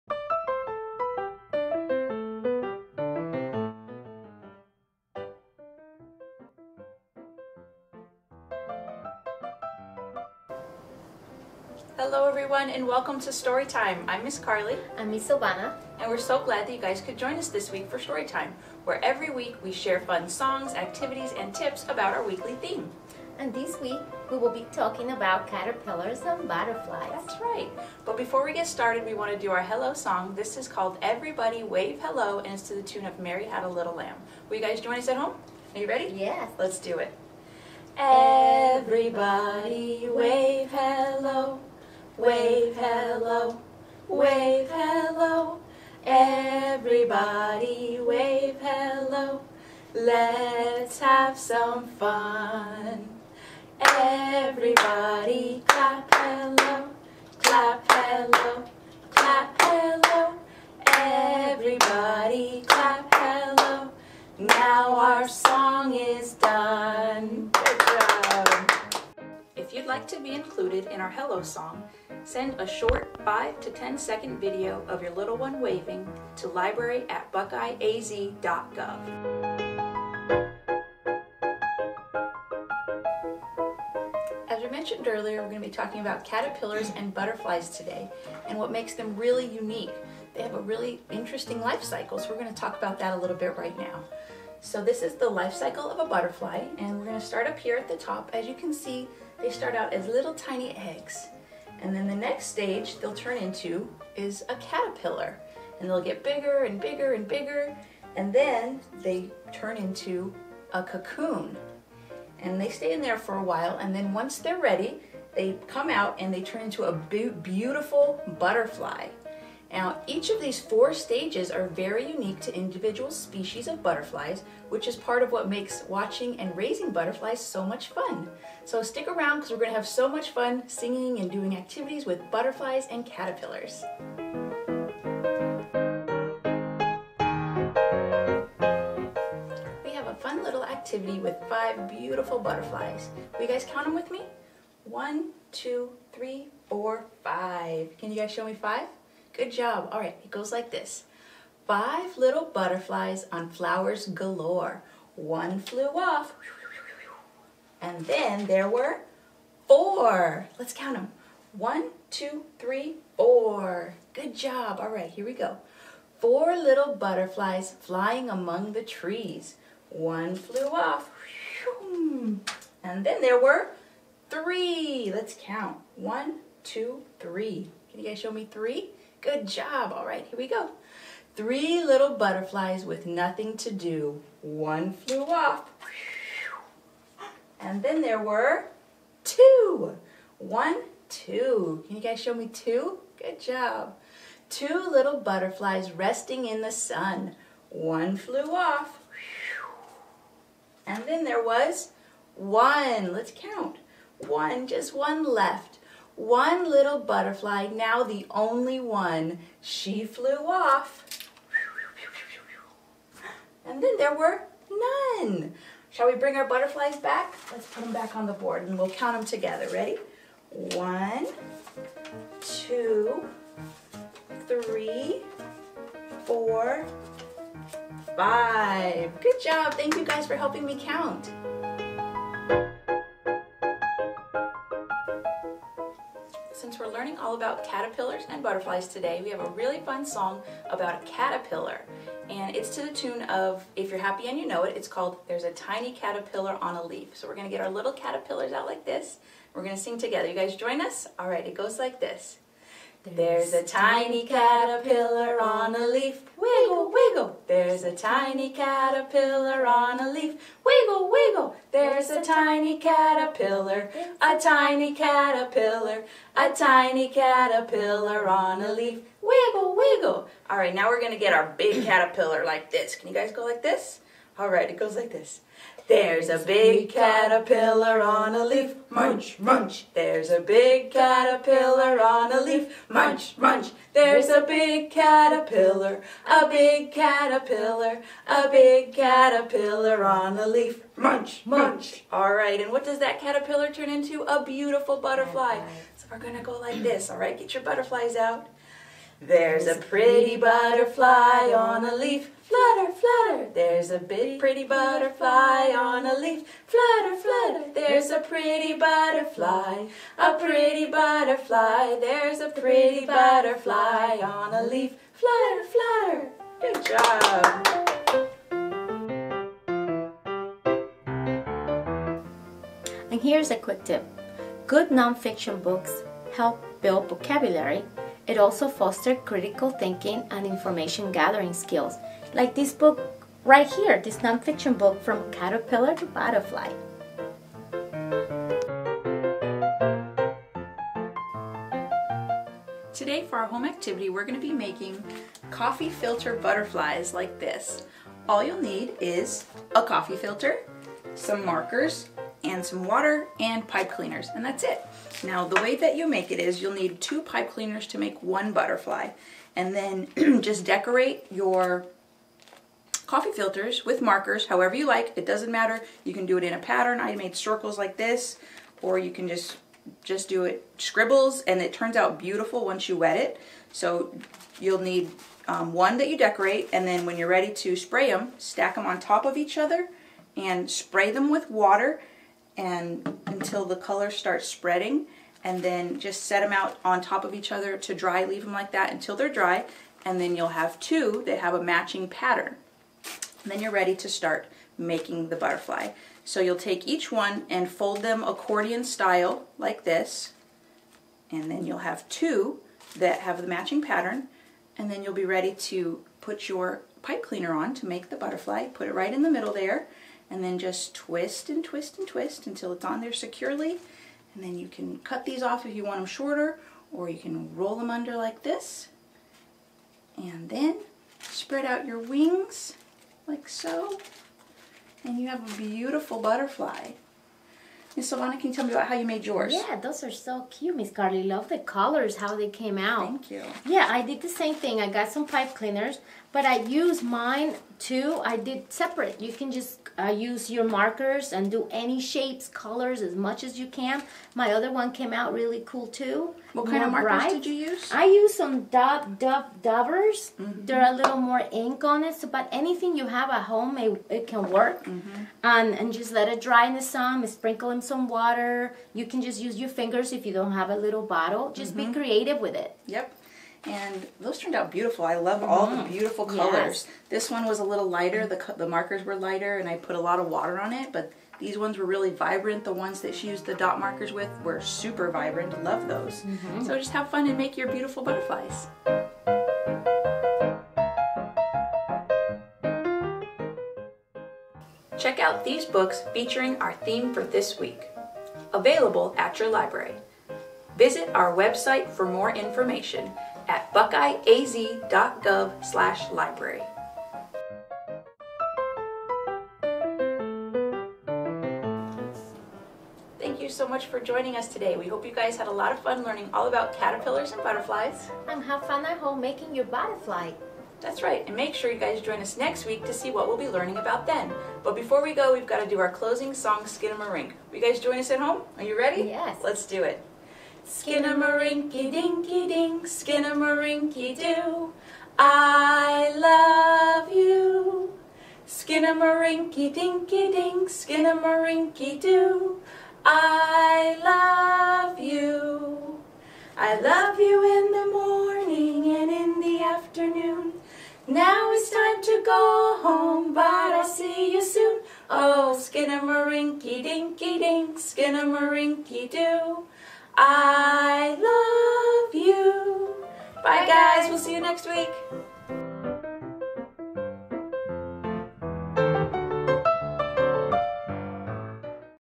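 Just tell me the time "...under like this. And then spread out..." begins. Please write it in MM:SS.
06:57.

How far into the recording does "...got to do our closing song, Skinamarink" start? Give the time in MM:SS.
08:35.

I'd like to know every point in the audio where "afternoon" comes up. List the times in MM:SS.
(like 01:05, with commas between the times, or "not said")
08:59.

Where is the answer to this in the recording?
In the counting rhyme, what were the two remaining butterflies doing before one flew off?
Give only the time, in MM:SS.
03:15.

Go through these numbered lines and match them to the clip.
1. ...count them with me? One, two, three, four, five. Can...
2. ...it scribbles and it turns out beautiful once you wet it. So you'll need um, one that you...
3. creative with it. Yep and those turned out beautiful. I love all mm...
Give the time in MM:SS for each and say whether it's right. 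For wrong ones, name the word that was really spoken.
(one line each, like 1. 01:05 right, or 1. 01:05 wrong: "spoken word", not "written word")
1. 02:23 right
2. 06:10 right
3. 07:41 right.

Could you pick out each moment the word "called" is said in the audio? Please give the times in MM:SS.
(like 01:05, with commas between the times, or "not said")
00:30, 04:04.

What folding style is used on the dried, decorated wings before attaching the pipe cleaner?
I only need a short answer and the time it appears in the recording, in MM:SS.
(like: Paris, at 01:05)
Accordion style, at 06:38.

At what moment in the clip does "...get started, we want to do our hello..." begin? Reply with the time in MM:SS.
00:28.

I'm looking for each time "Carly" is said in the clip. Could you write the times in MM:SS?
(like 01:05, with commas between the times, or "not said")
00:14, 07:10.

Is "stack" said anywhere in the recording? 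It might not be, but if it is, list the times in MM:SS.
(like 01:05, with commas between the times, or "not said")
06:18.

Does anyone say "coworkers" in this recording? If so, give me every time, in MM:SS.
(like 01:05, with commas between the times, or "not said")
not said.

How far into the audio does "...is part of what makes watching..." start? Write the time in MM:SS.
02:04.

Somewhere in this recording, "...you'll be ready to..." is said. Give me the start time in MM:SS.
06:45.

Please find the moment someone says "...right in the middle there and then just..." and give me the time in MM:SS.
06:48.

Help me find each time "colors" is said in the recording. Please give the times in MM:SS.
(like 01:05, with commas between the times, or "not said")
06:23, 07:11, 07:22, 07:46.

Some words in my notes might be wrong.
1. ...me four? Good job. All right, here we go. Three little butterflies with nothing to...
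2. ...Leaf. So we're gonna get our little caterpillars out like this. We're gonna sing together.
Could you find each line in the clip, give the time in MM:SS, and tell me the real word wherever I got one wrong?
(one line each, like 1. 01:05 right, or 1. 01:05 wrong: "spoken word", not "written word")
1. 02:58 wrong: "three", not "four"
2. 04:06 right.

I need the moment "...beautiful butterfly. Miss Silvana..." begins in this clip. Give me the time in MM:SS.
07:05.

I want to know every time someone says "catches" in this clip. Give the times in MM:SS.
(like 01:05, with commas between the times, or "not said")
not said.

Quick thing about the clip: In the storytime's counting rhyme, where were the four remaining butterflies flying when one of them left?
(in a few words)
Among the trees.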